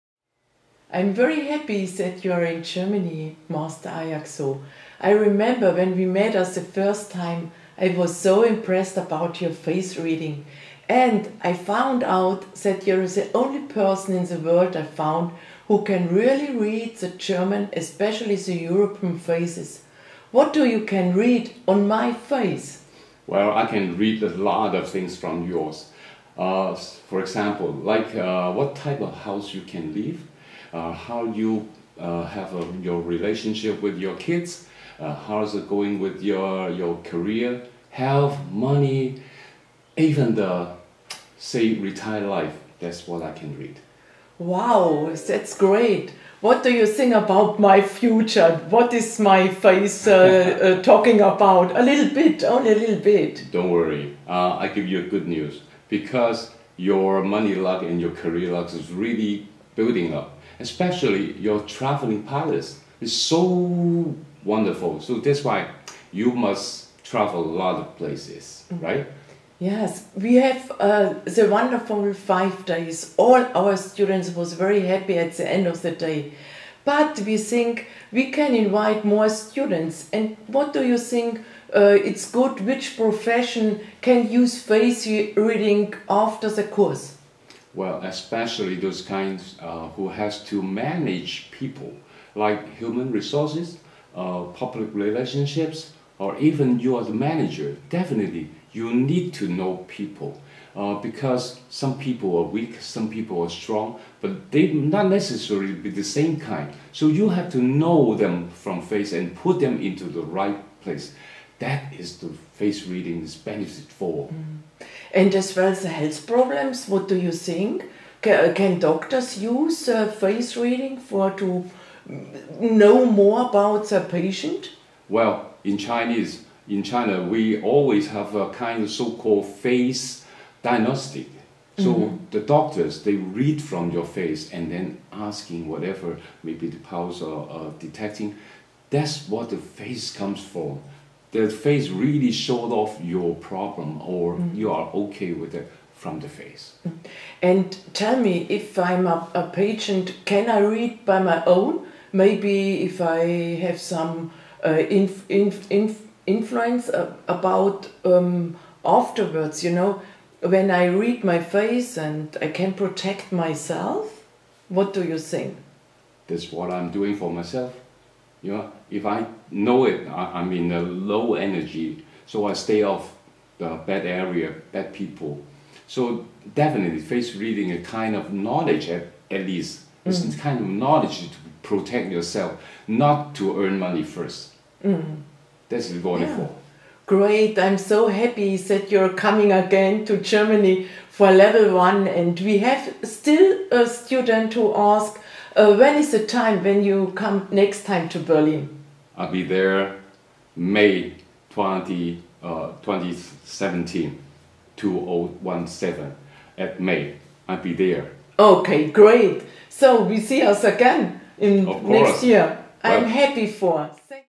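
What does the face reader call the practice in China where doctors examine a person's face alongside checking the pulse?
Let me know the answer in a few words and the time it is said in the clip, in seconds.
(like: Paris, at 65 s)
face diagnostic, at 129 s.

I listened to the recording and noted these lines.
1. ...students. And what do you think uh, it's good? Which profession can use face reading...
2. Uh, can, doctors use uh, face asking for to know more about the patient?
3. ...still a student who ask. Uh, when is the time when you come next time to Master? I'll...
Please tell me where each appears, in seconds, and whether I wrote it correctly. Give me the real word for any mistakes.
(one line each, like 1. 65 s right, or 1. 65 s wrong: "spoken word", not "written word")
1. 79 s right
2. 118 s wrong: "reading", not "asking"
3. 193 s wrong: "Berlin", not "Master".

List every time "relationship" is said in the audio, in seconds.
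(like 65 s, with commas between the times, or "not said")
33 s, 94 s.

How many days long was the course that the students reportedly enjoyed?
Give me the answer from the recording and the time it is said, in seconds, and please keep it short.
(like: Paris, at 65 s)
5, at 72 s.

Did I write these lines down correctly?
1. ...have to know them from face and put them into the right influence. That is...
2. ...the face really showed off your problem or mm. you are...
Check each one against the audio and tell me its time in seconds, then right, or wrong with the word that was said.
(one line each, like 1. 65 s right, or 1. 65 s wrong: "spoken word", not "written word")
1. 107 s wrong: "place", not "influence"
2. 141 s right.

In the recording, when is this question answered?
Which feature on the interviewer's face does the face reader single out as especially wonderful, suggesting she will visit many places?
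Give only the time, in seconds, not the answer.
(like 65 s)
61 s.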